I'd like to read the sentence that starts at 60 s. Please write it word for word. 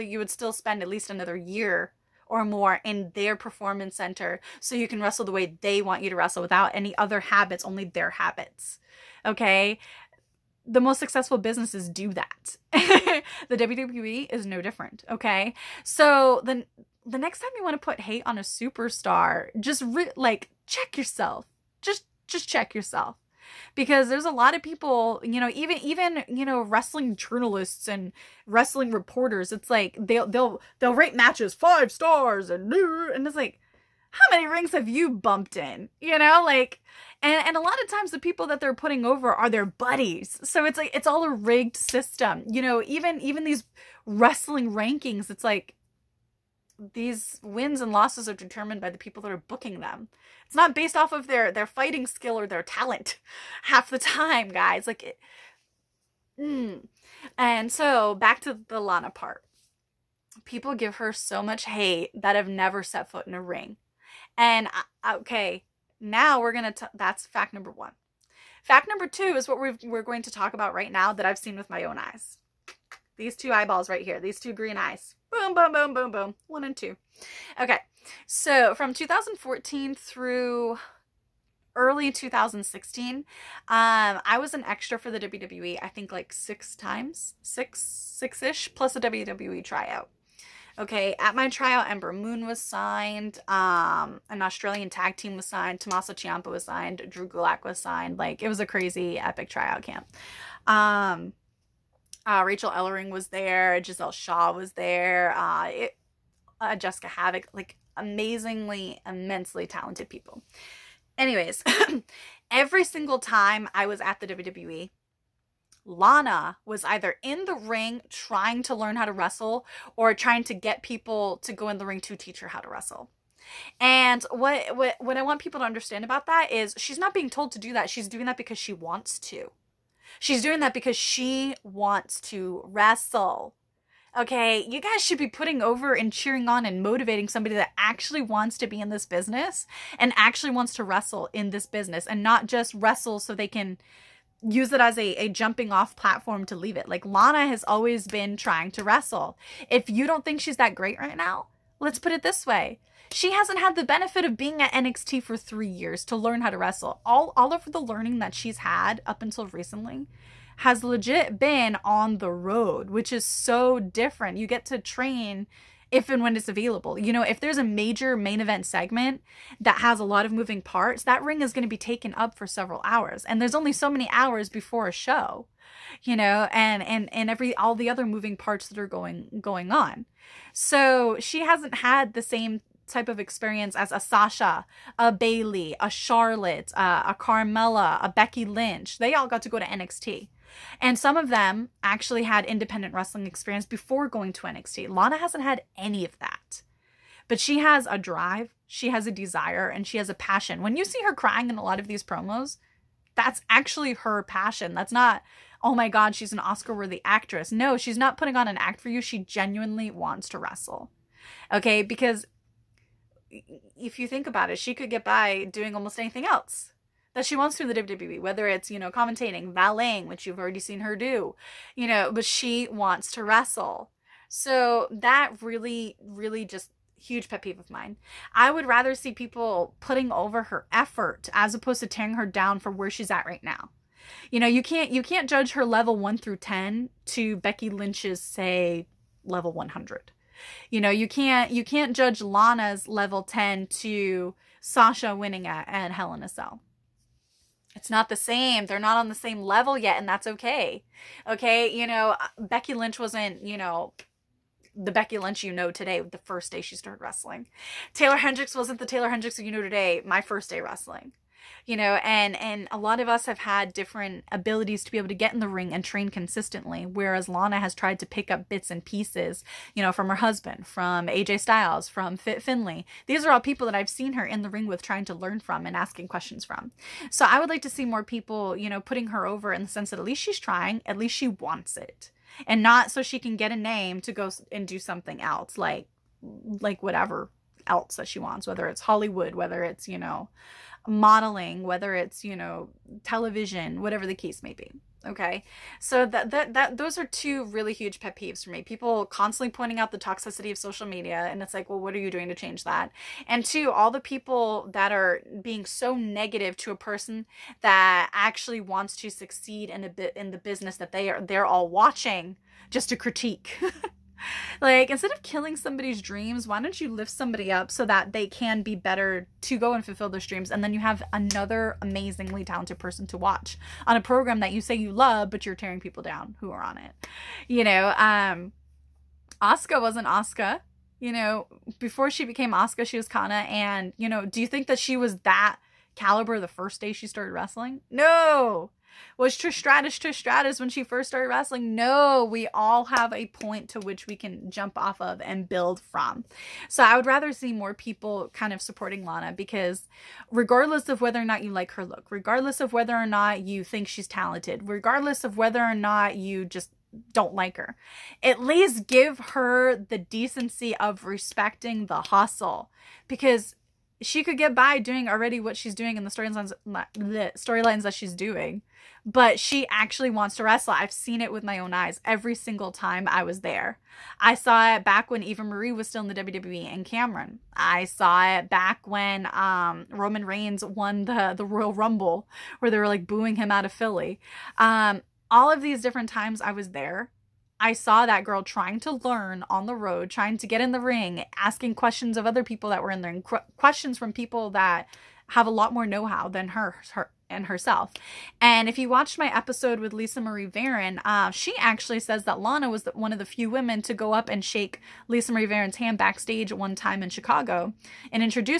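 People give her so much hate that have never set foot in a ring.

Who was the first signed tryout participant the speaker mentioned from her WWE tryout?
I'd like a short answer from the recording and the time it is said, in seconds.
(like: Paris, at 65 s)
Ember Moon, at 91 s.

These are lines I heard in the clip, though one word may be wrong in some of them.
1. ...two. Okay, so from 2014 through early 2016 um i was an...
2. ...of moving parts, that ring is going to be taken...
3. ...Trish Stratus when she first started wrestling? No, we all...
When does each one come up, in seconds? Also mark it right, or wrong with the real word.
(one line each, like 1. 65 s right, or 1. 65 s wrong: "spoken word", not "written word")
1. 76 s right
2. 170 s right
3. 339 s right.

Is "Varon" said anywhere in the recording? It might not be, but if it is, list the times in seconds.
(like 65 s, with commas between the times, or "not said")
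400 s, 405 s.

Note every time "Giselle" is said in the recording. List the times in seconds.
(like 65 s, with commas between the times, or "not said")
103 s.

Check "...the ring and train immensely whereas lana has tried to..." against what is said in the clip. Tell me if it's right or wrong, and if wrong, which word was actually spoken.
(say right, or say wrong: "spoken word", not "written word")
wrong: "consistently", not "immensely".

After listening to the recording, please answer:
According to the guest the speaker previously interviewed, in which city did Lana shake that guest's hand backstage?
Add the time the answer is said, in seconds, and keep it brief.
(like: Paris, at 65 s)
Chicago, at 407 s.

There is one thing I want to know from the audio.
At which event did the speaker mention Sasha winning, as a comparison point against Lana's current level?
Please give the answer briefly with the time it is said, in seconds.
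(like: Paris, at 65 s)
Hell in a Cell, at 245 s.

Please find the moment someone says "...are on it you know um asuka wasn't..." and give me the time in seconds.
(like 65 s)
326 s.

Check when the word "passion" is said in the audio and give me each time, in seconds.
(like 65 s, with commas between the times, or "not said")
200 s, 204 s.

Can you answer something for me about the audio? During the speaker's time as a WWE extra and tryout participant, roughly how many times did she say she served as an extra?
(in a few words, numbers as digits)
6.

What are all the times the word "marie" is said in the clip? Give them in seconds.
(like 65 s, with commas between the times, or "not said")
375 s, 400 s, 405 s.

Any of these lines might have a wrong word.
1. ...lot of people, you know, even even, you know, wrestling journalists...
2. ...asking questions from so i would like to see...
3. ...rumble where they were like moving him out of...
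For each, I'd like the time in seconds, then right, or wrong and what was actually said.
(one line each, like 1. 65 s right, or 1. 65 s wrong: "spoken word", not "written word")
1. 24 s right
2. 275 s right
3. 381 s wrong: "booing", not "moving".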